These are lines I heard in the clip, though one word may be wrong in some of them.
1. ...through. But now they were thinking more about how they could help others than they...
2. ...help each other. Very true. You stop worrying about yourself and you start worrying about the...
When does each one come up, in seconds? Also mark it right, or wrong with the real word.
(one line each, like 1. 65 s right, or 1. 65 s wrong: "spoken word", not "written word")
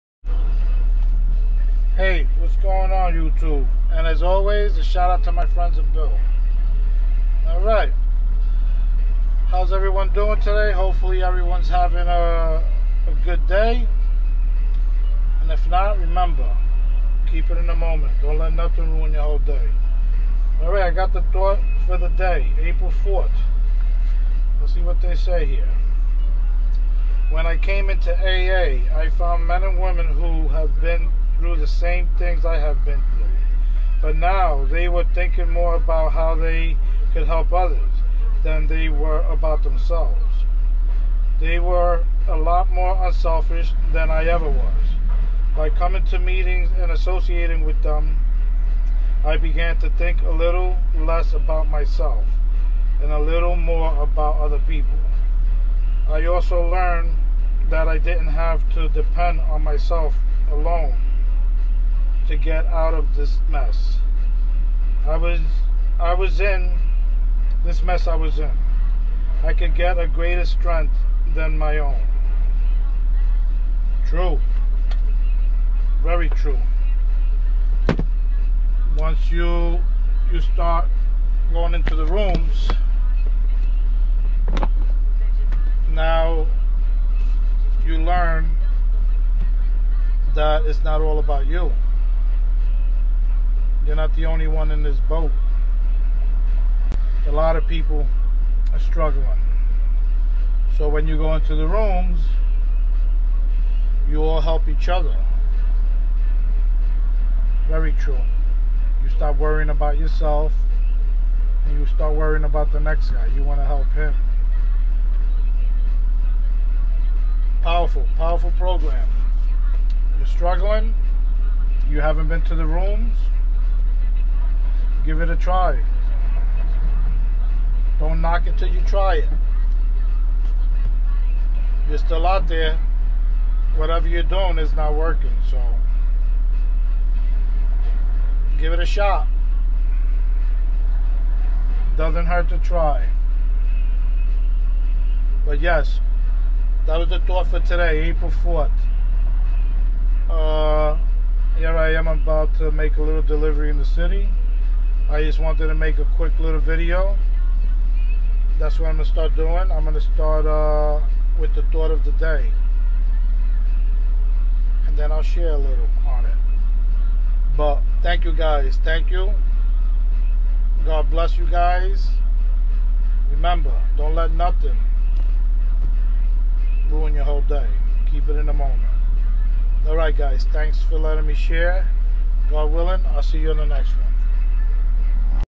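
1. 33 s right
2. 104 s right.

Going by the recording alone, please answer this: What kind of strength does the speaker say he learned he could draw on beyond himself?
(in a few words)
A greater strength.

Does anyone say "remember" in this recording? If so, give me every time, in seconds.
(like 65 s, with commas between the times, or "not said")
15 s, 173 s.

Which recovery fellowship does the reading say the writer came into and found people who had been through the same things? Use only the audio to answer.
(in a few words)
AA.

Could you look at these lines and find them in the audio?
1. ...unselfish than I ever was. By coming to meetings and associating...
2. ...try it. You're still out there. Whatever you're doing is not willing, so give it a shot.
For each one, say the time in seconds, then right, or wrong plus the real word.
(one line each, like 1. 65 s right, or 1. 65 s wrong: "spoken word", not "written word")
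1. 43 s right
2. 128 s wrong: "working", not "willing".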